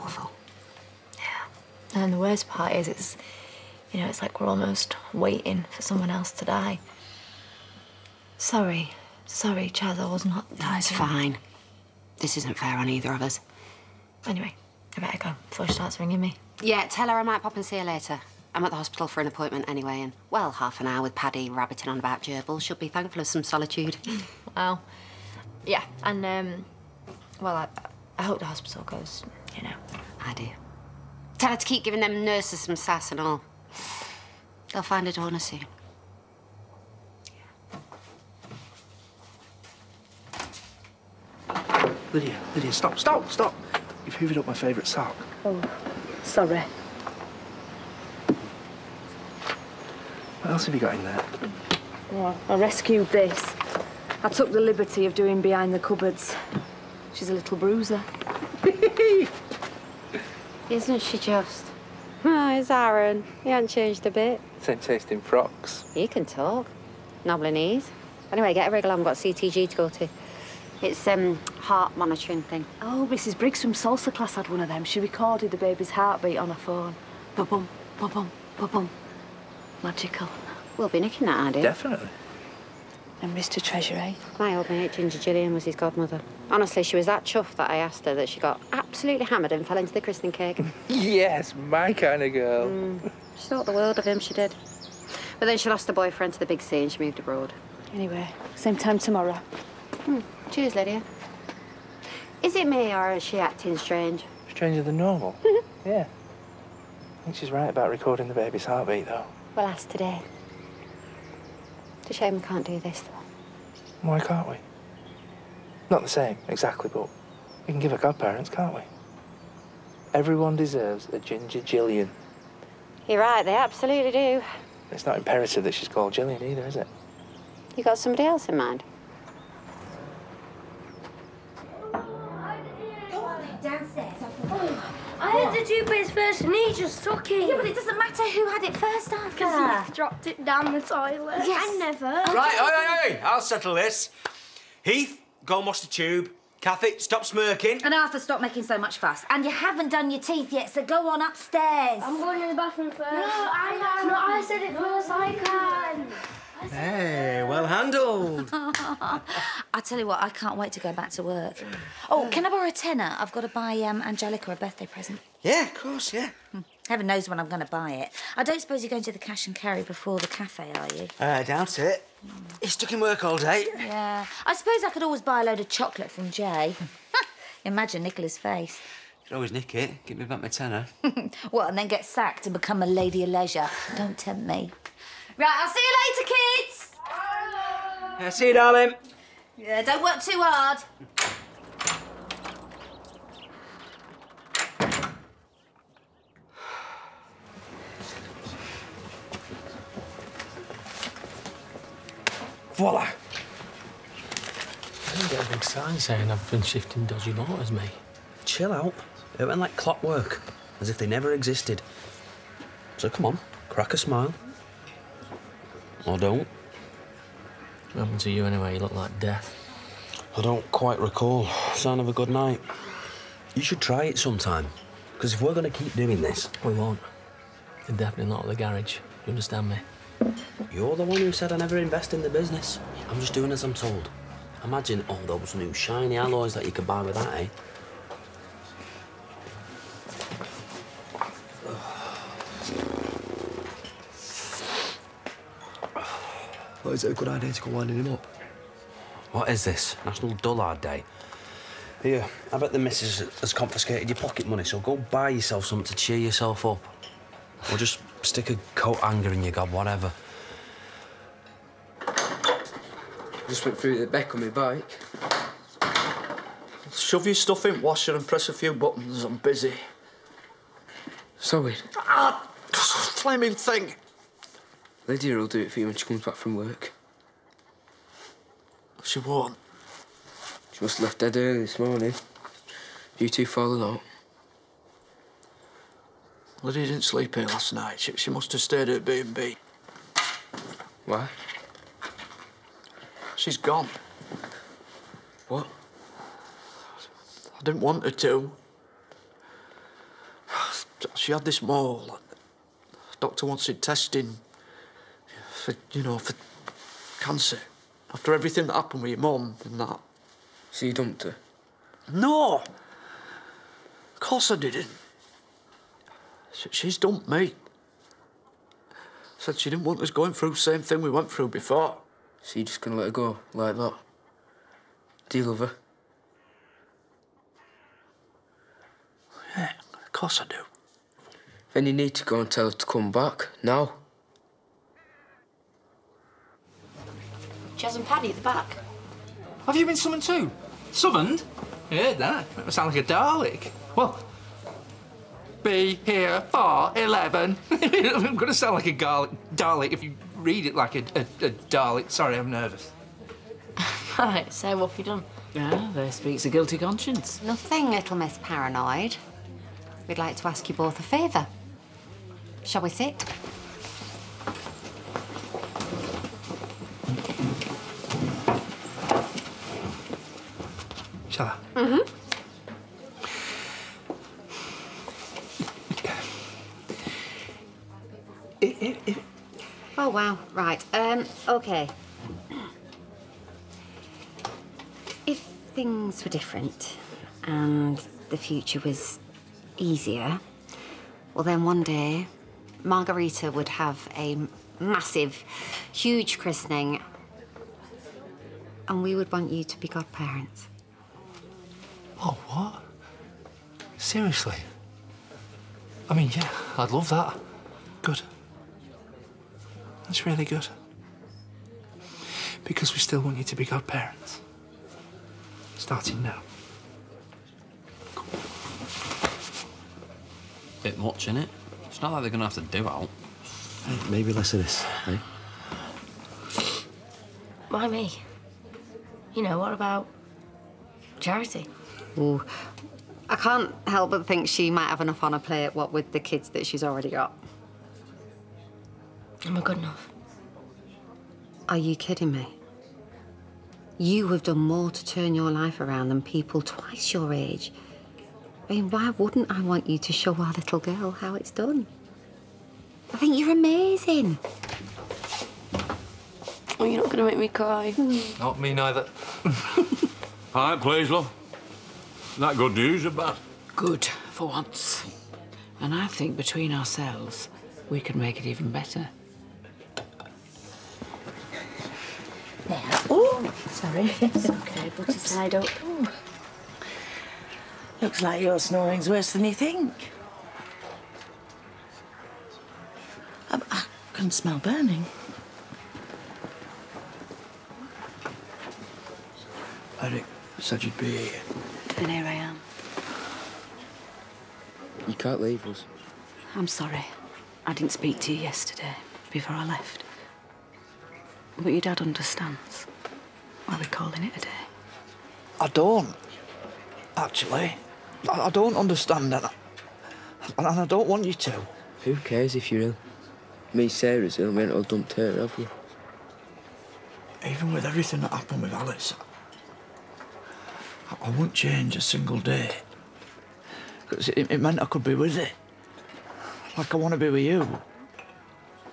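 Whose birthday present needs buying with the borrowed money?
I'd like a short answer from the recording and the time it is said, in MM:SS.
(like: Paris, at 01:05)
Angelica, at 02:44.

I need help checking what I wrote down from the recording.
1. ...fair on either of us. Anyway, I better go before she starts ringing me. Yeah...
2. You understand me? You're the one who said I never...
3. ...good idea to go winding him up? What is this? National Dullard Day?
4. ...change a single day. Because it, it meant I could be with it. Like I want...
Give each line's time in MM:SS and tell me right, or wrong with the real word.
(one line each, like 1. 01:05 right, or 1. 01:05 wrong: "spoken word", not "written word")
1. 00:12 right
2. 03:49 right
3. 04:07 right
4. 08:41 right.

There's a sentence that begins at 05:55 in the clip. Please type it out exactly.
Ah, there speaks a guilty conscience.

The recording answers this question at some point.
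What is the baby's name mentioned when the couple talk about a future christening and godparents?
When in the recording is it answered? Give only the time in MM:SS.
06:32.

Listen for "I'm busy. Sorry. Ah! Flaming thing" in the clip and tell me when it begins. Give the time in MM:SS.
04:29.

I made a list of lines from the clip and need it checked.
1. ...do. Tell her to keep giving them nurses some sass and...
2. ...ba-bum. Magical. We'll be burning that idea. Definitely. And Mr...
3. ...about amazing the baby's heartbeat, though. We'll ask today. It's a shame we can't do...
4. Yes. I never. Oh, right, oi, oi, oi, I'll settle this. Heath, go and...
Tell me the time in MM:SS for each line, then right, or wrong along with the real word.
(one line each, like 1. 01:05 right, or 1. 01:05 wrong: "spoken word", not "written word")
1. 00:30 right
2. 01:18 wrong: "nicking", not "burning"
3. 01:47 wrong: "recording", not "amazing"
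4. 02:21 right.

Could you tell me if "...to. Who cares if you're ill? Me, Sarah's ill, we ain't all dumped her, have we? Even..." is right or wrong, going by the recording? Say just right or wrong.
right.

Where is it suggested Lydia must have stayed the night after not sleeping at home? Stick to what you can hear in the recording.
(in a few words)
B&B.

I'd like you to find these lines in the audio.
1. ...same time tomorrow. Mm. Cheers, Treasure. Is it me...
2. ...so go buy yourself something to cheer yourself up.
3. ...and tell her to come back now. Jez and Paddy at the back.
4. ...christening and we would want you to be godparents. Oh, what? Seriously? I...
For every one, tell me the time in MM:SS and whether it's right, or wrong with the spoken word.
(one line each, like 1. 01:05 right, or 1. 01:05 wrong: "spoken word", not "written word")
1. 01:38 wrong: "Lydia", not "Treasure"
2. 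04:14 right
3. 05:32 right
4. 06:36 right.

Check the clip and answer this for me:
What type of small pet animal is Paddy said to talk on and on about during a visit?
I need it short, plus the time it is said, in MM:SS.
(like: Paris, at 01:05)
Gerbils, at 00:22.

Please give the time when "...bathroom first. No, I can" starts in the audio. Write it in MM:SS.
02:32.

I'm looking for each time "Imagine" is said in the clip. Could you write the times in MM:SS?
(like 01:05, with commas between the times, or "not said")
02:57, 03:54.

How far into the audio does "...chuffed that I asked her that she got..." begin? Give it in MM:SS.
01:27.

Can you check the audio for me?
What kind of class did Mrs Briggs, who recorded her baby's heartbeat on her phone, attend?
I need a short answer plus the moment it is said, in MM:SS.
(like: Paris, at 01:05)
Salsa, at 01:13.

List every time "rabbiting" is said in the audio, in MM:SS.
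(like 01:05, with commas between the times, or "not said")
00:21.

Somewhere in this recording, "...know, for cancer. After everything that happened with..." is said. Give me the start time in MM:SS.
05:06.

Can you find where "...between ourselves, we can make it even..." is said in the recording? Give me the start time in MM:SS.
07:46.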